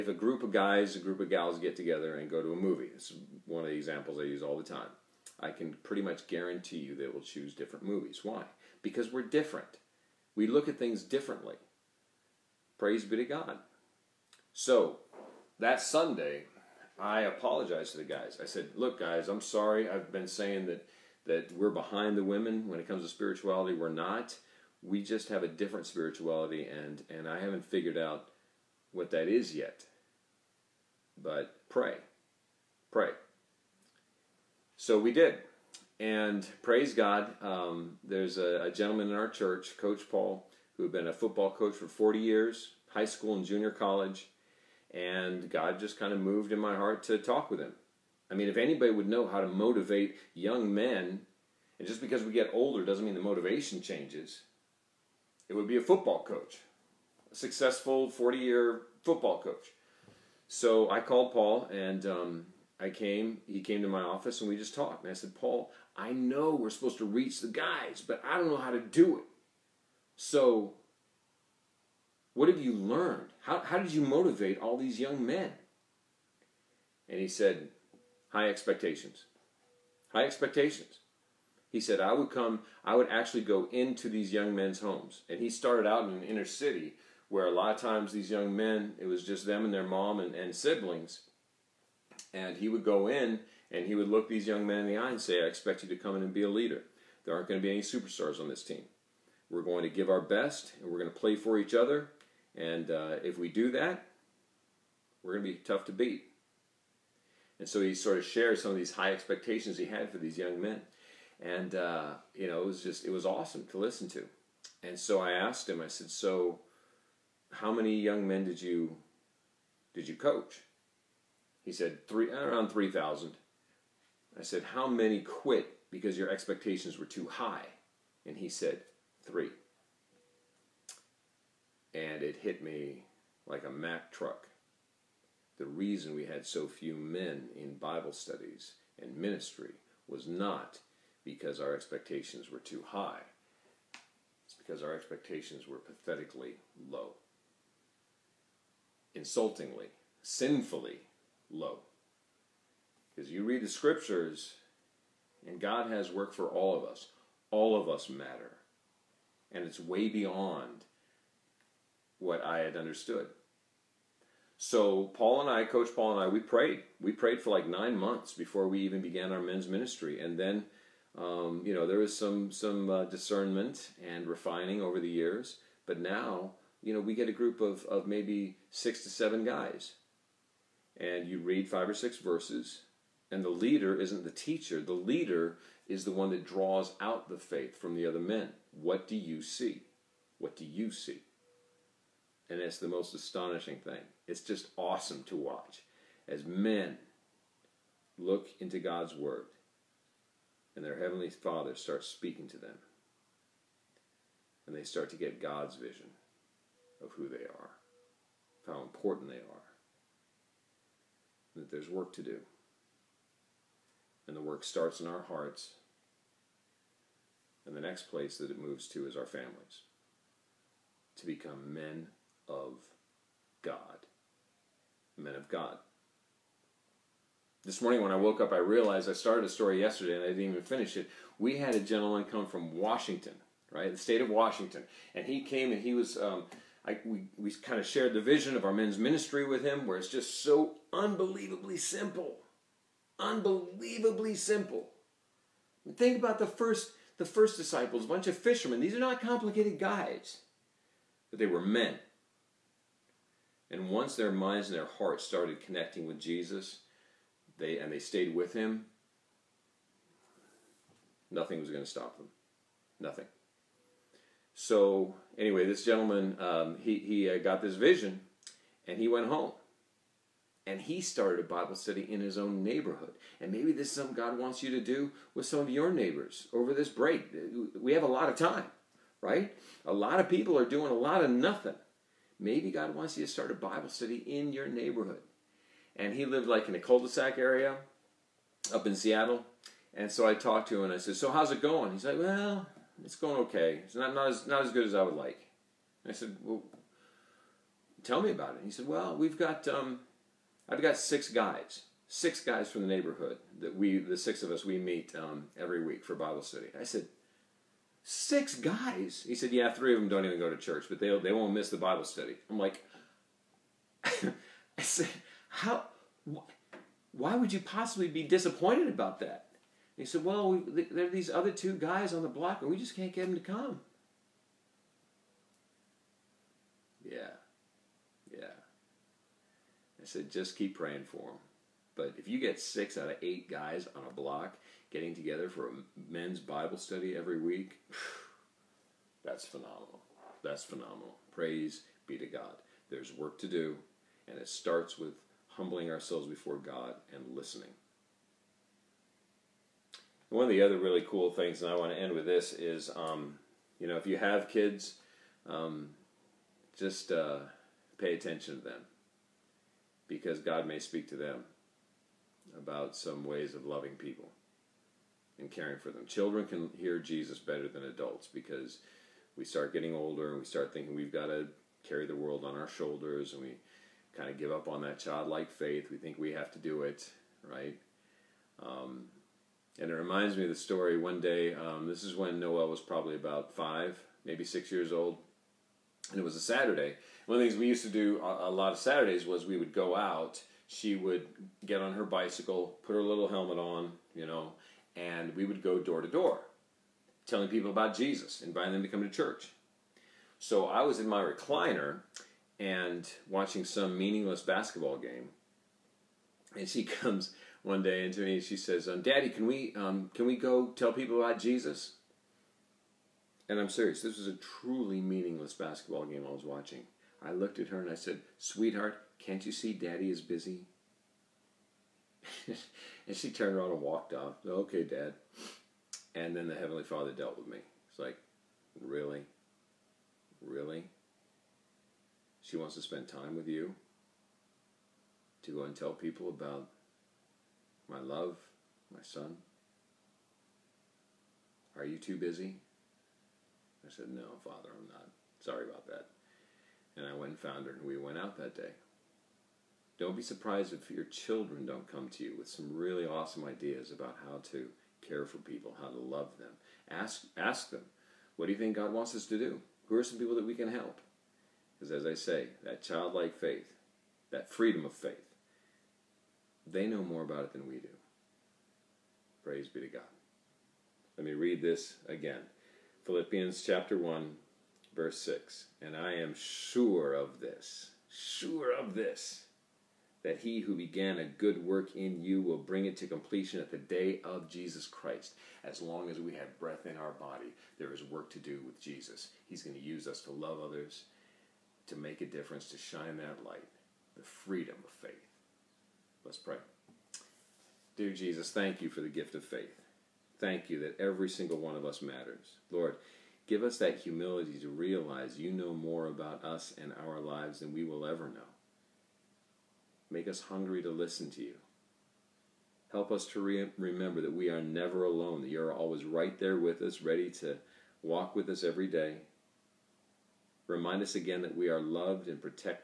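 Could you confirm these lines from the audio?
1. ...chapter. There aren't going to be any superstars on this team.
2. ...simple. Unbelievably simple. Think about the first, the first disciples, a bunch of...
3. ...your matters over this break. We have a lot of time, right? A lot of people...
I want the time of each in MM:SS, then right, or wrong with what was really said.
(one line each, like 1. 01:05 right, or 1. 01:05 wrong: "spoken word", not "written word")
1. 01:36 wrong: "leader", not "chapter"
2. 04:01 right
3. 04:35 wrong: "neighbors", not "matters".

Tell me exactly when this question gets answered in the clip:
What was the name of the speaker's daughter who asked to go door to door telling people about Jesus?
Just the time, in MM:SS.
06:22.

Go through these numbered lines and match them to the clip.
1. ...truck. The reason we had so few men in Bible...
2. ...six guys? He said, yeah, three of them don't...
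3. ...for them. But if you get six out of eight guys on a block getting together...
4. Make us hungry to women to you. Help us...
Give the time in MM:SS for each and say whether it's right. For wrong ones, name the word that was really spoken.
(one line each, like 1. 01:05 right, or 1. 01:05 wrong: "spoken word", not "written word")
1. 02:14 right
2. 05:08 right
3. 05:31 right
4. 08:30 wrong: "listen", not "women".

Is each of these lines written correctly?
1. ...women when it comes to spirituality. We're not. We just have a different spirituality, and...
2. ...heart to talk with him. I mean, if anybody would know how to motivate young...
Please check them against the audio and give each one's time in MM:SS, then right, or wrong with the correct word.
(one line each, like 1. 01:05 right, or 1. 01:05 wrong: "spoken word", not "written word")
1. 00:22 right
2. 00:46 right.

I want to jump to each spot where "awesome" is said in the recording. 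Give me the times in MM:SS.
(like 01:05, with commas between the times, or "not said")
01:53, 03:14, 07:33.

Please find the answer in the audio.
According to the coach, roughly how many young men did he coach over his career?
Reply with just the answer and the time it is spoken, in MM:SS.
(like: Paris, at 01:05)
3,000, at 02:02.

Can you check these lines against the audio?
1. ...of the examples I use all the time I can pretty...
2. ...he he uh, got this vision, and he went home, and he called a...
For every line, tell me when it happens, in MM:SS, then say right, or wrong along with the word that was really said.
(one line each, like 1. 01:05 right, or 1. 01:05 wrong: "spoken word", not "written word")
1. 00:03 right
2. 04:26 wrong: "started", not "called".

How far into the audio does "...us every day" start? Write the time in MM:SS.
08:38.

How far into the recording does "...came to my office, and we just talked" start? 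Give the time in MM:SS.
01:03.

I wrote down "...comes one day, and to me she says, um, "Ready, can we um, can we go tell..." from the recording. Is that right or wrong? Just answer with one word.
wrong.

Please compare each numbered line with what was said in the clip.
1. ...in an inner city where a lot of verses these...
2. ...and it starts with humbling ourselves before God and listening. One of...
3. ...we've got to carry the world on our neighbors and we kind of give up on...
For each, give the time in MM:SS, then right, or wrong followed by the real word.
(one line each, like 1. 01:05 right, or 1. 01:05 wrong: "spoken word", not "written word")
1. 01:26 wrong: "times", not "verses"
2. 05:44 right
3. 06:10 wrong: "shoulders", not "neighbors".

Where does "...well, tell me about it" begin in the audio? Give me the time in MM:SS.
04:56.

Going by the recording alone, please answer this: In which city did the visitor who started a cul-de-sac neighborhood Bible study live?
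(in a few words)
Seattle.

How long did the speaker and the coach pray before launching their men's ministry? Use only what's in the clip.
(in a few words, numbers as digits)
9 months.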